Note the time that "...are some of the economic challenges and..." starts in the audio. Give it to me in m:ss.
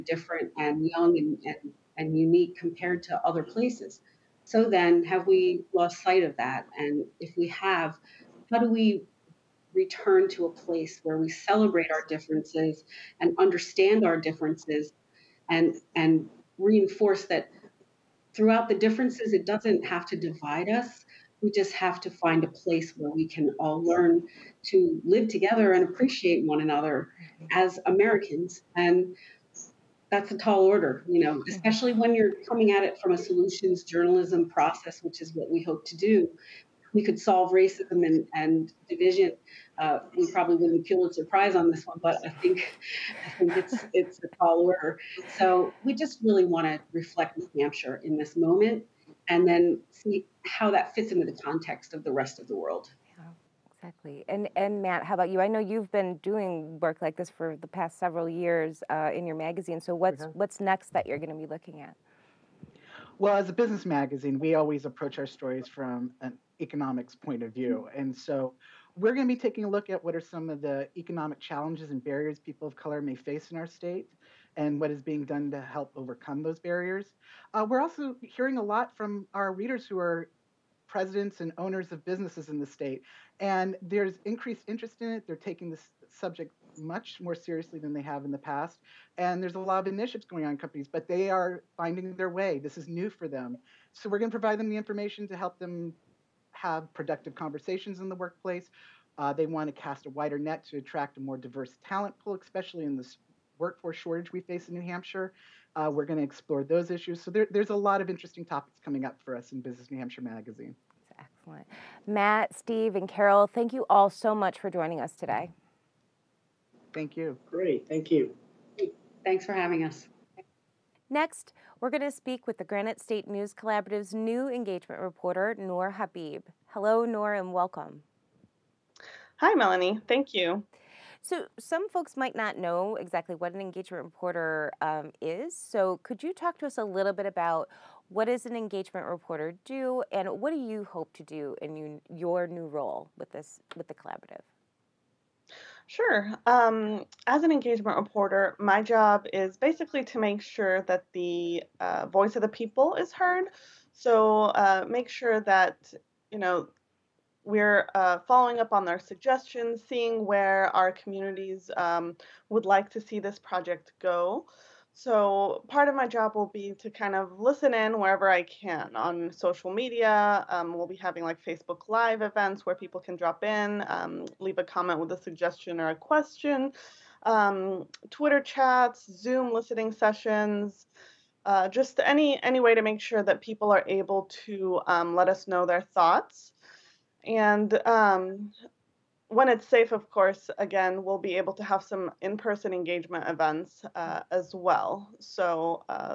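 1:10.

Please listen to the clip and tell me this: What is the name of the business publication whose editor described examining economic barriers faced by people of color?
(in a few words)
Business New Hampshire Magazine.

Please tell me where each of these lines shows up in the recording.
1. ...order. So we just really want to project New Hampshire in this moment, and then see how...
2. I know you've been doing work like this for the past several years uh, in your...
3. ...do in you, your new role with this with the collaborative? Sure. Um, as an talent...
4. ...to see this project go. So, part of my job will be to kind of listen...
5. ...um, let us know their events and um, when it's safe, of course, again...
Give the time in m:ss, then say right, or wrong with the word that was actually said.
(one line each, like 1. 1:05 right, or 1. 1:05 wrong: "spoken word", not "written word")
1. 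0:44 wrong: "reflect", not "project"
2. 0:55 right
3. 2:21 wrong: "engagement", not "talent"
4. 2:42 right
5. 3:04 wrong: "thoughts", not "events".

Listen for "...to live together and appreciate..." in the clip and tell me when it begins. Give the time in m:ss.
0:24.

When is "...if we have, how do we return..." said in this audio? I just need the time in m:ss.
0:07.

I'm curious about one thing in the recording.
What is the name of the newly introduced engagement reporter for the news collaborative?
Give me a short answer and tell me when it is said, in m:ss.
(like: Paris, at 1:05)
Noor Habib, at 2:05.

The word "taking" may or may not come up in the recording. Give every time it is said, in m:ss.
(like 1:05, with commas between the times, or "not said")
1:09, 1:25.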